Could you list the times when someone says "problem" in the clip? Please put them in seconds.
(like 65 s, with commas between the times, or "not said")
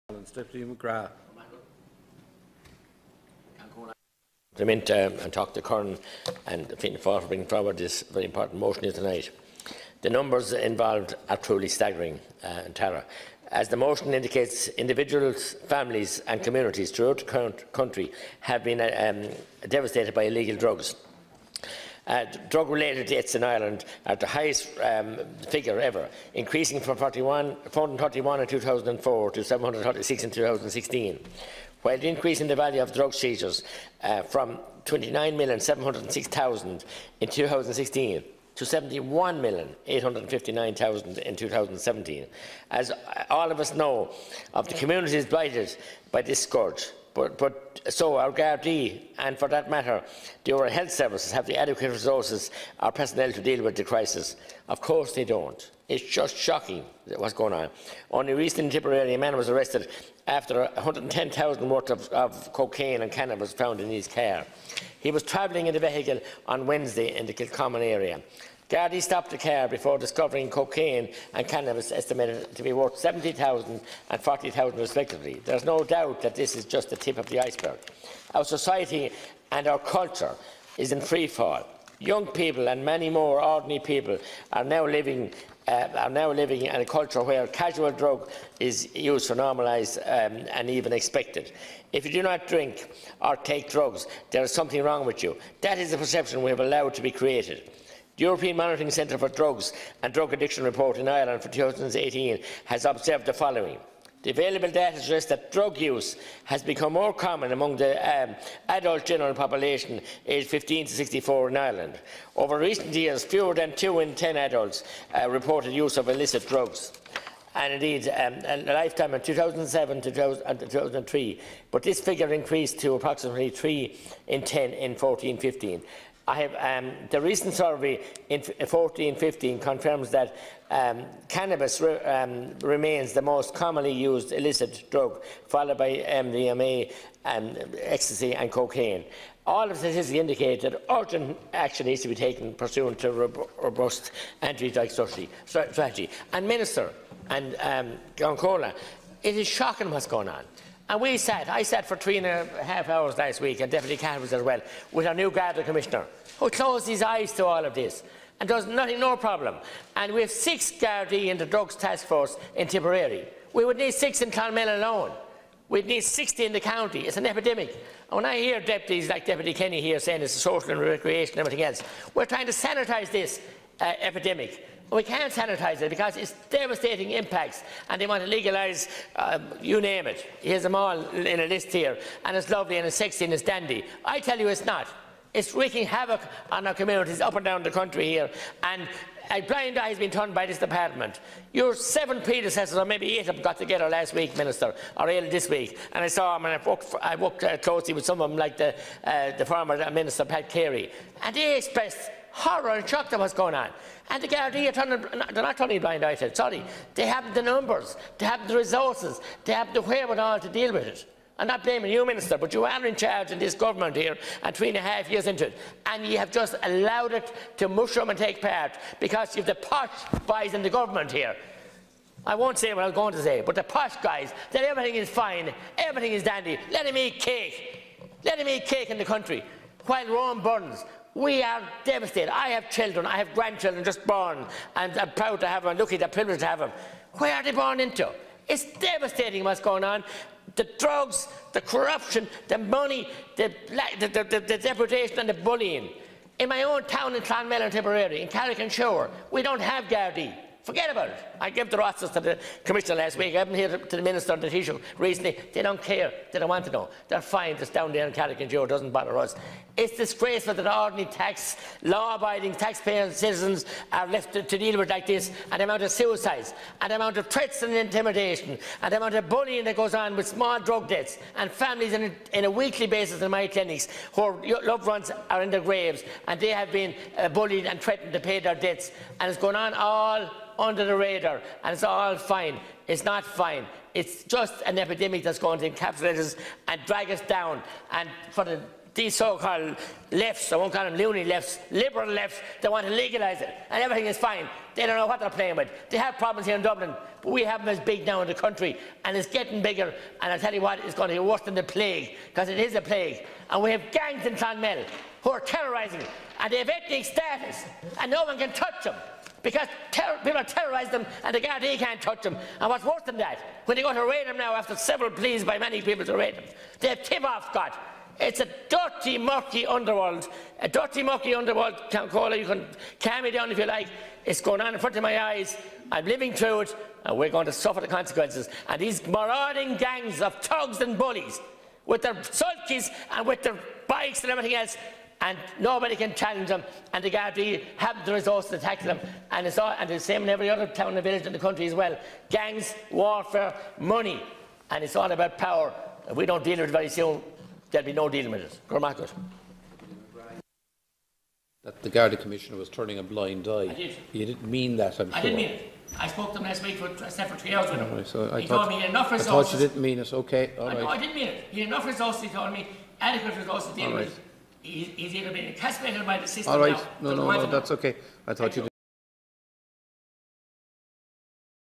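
159 s, 296 s.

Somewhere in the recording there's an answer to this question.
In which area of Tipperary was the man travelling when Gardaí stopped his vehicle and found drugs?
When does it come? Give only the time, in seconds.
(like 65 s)
67 s.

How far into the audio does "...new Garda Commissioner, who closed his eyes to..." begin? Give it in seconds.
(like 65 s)
155 s.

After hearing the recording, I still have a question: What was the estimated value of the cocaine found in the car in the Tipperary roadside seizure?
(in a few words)
70,000.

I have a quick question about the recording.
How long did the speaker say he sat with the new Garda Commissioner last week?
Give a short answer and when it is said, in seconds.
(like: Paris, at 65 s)
3 and a half hours, at 151 s.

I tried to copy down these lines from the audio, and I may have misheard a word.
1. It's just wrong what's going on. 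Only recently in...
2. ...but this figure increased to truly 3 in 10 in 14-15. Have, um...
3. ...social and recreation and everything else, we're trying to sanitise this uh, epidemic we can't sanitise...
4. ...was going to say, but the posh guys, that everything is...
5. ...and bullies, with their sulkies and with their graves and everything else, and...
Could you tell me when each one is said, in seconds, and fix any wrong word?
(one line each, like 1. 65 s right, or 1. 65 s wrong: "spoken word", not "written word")
1. 55 s wrong: "shocking", not "wrong"
2. 121 s wrong: "approximately", not "truly"
3. 170 s right
4. 222 s right
5. 330 s wrong: "bikes", not "graves".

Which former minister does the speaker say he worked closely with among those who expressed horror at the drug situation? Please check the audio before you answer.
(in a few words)
Pat Carey.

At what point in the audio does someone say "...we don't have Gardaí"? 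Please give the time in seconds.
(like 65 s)
249 s.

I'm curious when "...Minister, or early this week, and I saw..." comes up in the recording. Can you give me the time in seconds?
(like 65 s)
194 s.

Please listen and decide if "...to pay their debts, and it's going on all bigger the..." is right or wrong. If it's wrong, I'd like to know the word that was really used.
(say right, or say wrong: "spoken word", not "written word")
wrong: "under", not "bigger".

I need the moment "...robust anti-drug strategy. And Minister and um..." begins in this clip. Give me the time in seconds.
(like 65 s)
143 s.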